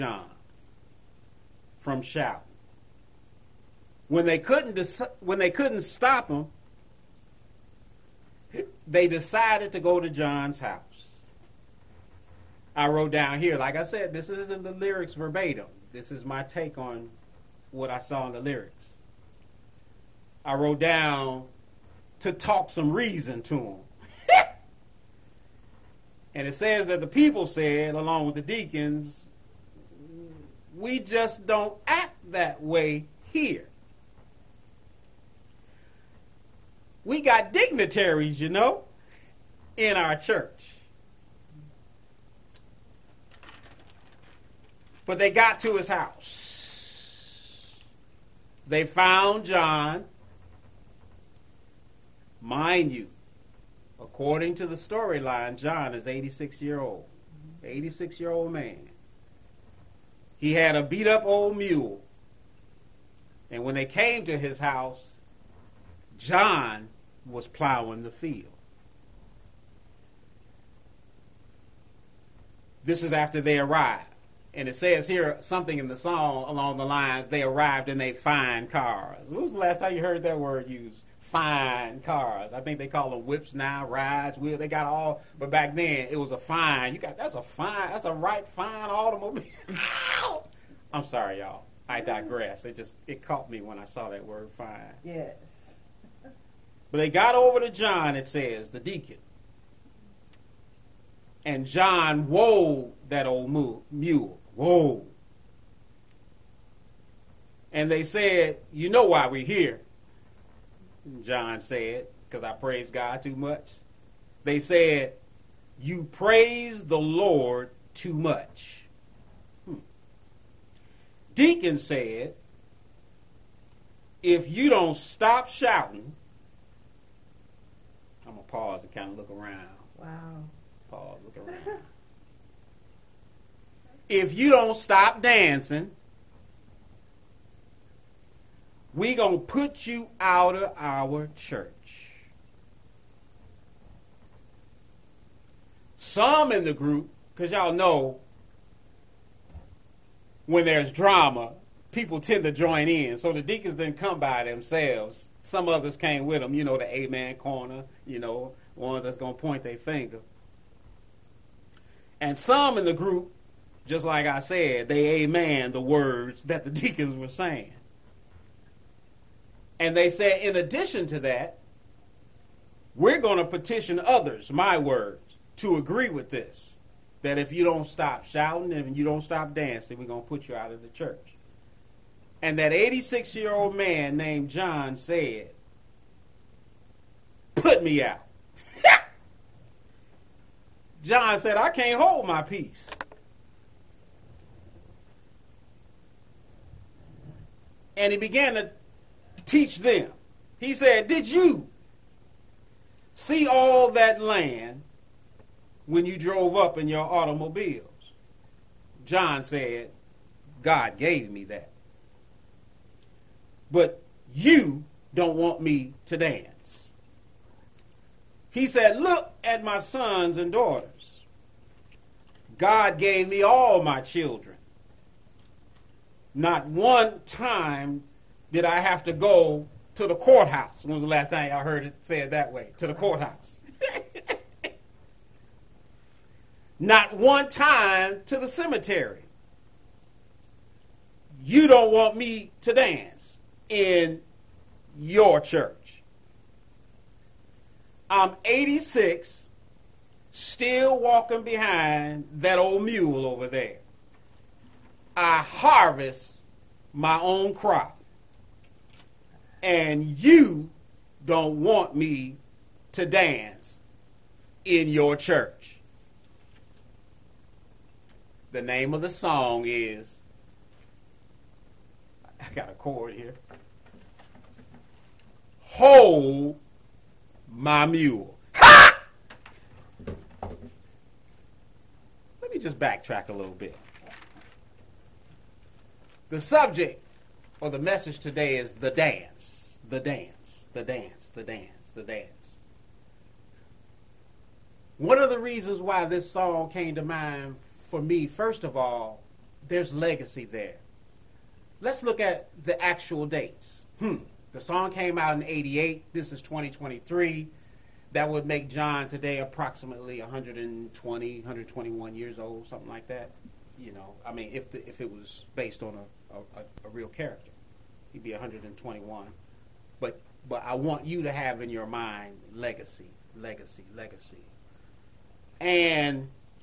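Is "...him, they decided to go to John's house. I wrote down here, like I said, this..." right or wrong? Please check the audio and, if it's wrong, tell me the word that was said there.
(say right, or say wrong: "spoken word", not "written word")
right.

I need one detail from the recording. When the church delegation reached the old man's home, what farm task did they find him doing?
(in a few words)
plowing the field.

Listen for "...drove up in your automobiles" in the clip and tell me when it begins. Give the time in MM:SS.
03:26.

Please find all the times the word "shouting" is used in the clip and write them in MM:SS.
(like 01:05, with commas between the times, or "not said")
00:02, 02:05, 02:58.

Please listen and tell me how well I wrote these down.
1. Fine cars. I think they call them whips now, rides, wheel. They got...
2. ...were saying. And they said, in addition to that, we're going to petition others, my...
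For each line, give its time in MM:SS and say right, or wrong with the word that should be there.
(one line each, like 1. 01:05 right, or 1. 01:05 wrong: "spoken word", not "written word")
1. 01:21 right
2. 02:47 right.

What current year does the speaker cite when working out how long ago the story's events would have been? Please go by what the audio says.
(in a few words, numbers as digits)
2023.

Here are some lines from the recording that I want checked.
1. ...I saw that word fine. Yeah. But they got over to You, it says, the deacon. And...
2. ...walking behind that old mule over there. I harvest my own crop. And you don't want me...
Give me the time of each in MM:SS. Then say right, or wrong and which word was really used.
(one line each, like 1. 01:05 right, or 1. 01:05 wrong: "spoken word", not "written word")
1. 01:33 wrong: "John", not "You"
2. 04:10 right.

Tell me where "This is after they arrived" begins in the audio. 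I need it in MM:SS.
01:12.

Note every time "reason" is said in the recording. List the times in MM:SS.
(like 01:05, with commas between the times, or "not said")
00:22, 04:55.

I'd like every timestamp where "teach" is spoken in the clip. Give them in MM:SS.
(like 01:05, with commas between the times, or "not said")
03:19.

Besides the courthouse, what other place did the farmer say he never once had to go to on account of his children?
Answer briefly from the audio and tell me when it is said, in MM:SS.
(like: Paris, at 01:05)
the cemetery, at 03:58.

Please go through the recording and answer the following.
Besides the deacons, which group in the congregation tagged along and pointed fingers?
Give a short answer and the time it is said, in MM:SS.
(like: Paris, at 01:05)
the amen corner, at 02:36.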